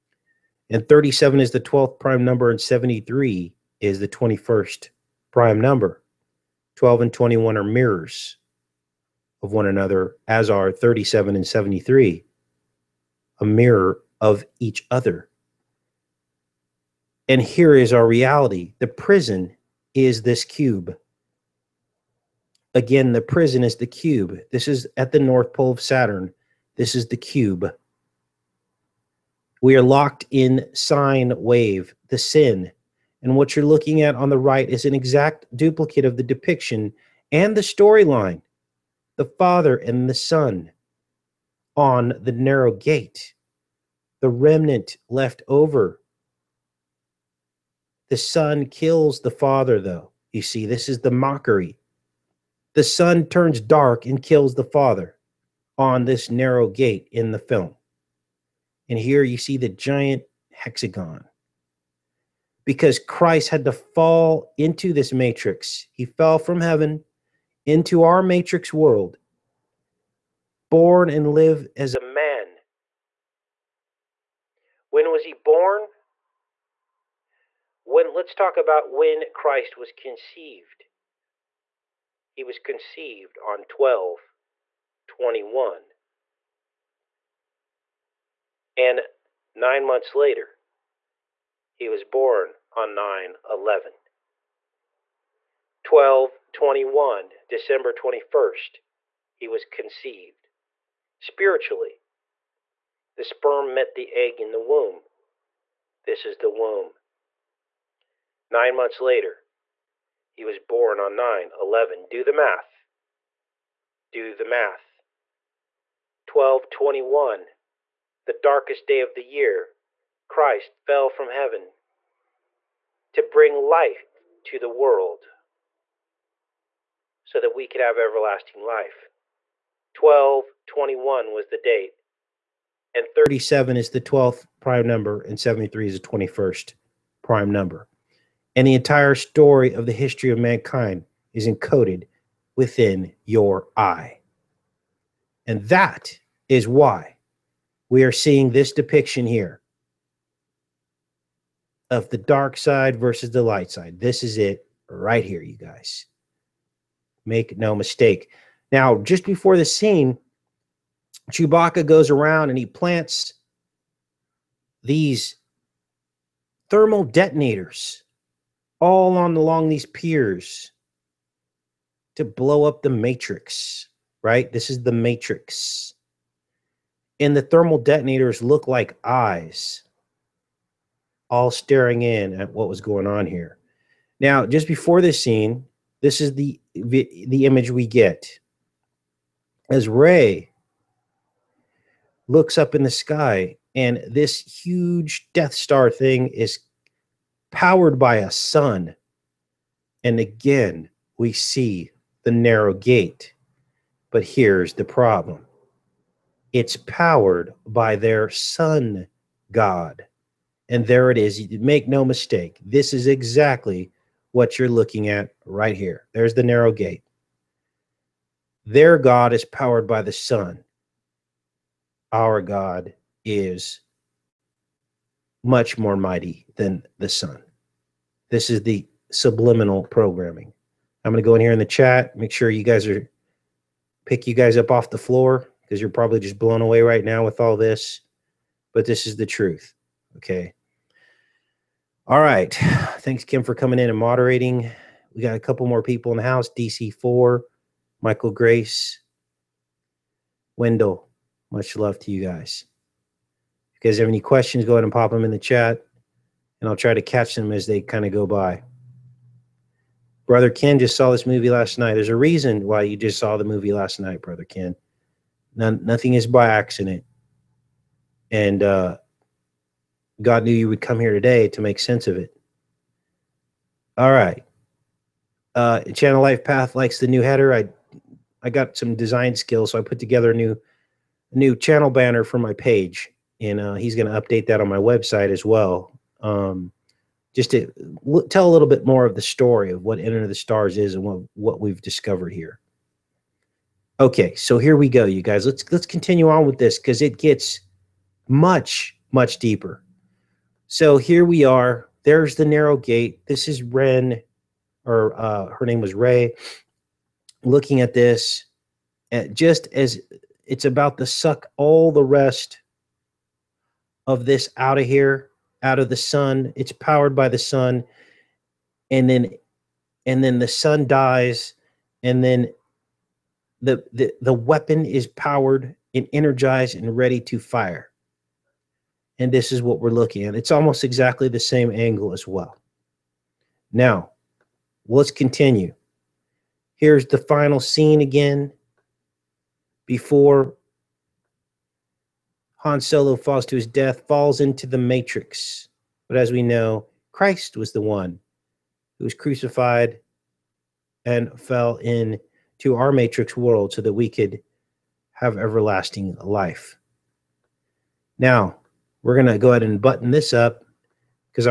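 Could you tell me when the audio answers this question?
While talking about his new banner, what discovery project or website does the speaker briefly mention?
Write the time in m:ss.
4:49.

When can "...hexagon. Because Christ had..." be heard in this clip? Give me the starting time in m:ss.
1:00.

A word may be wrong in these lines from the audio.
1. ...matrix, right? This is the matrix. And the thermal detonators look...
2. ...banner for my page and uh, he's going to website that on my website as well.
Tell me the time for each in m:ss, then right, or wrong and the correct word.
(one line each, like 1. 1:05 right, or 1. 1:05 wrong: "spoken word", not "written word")
1. 2:52 right
2. 4:41 wrong: "update", not "website".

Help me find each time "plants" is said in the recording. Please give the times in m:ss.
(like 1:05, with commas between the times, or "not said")
2:42.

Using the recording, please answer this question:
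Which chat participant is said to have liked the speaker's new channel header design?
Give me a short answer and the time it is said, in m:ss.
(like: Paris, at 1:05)
Channel Life Path, at 4:35.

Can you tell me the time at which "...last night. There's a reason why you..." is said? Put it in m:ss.
4:21.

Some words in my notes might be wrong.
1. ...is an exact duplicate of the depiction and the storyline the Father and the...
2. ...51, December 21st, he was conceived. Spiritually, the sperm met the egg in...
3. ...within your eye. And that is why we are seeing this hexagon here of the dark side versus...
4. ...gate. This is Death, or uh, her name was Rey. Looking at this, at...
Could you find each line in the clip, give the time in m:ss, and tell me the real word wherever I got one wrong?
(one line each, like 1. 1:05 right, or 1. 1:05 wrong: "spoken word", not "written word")
1. 0:34 right
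2. 1:36 wrong: "21", not "51"
3. 2:22 wrong: "depiction", not "hexagon"
4. 5:02 wrong: "Ren", not "Death".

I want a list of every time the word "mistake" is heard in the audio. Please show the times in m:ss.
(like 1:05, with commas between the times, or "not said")
2:37, 3:32.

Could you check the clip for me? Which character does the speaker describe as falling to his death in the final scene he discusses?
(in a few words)
Han Solo.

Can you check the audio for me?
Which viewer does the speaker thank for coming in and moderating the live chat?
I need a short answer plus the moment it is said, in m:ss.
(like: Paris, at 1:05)
Kim, at 4:03.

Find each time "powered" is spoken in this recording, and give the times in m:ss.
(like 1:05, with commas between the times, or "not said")
3:17, 3:26, 3:39, 5:16, 5:25.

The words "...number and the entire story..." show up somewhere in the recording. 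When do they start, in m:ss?
2:17.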